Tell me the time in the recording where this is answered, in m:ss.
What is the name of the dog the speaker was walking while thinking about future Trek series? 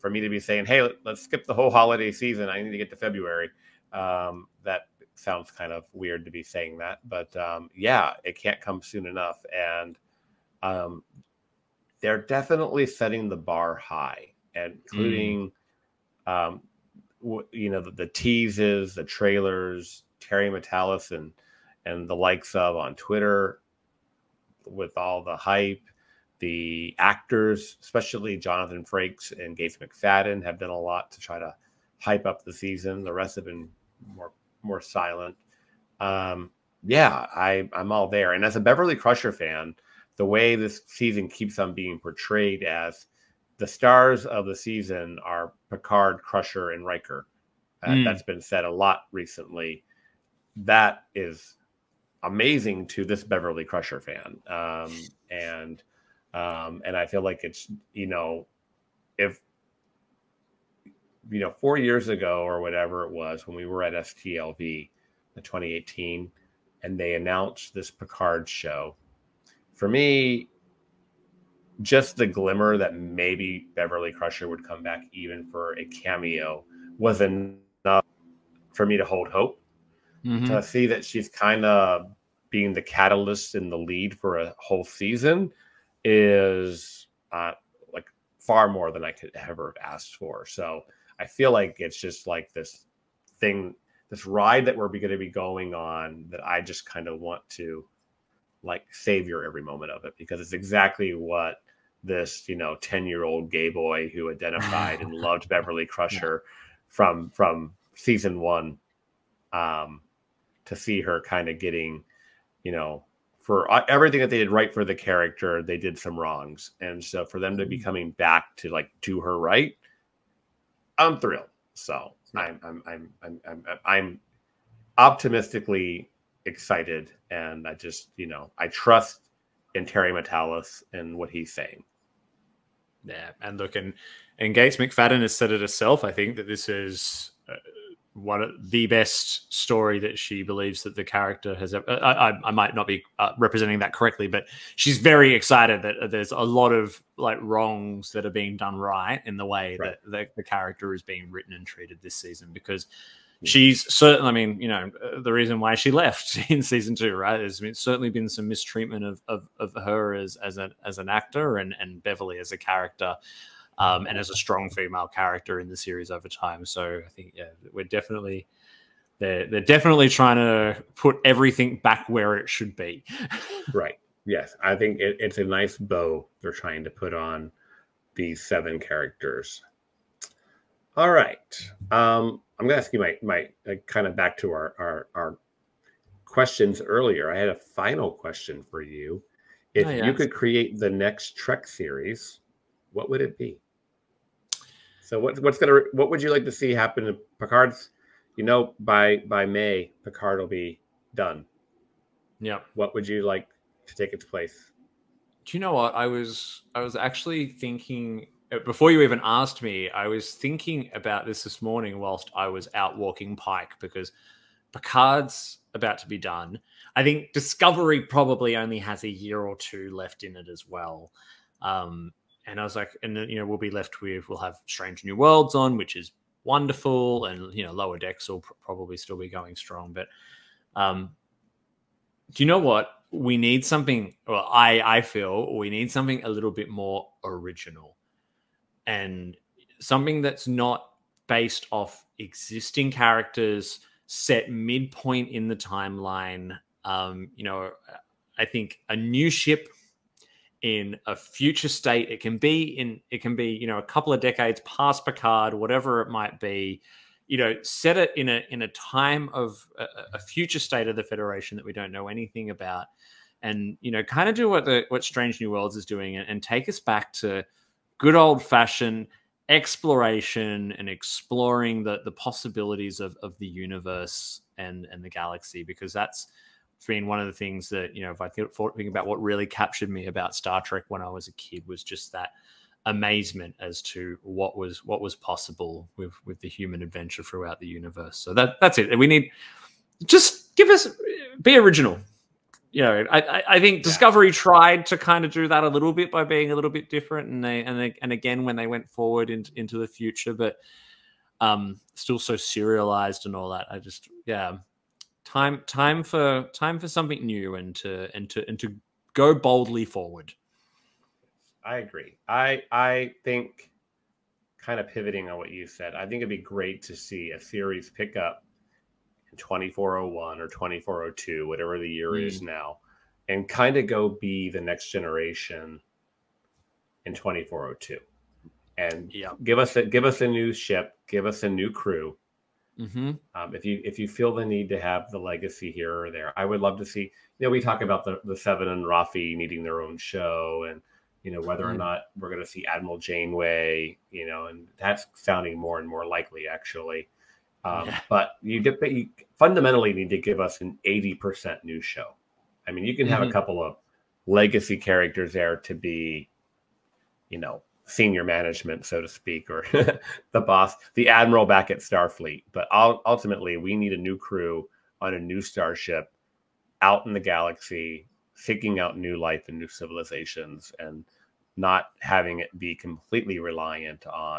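3:33.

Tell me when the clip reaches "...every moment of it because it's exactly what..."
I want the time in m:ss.
1:39.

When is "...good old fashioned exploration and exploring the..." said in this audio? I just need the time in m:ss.
4:28.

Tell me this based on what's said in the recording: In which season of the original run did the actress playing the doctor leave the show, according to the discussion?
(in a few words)
Season two.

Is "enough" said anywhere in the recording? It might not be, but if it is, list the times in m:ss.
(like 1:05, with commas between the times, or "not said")
0:09, 1:17.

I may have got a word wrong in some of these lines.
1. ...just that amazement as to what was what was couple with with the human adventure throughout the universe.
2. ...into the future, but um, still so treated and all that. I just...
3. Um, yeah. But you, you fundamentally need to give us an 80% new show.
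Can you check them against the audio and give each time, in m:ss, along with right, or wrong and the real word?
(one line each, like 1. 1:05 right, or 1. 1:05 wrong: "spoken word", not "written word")
1. 4:41 wrong: "possible", not "couple"
2. 4:59 wrong: "serialized", not "treated"
3. 5:47 right.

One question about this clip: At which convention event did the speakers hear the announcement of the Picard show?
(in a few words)
STLV.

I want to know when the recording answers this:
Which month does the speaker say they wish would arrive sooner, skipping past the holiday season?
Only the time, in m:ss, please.
0:02.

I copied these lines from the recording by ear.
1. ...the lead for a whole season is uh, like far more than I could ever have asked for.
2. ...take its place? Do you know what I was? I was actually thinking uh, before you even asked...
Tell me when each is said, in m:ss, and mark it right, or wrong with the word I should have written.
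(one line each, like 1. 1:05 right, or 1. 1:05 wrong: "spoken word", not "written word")
1. 1:23 right
2. 3:23 right.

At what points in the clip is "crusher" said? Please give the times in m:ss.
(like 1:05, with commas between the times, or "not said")
0:38, 0:46, 0:53, 1:14, 1:45.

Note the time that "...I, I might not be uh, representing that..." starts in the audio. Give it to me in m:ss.
2:22.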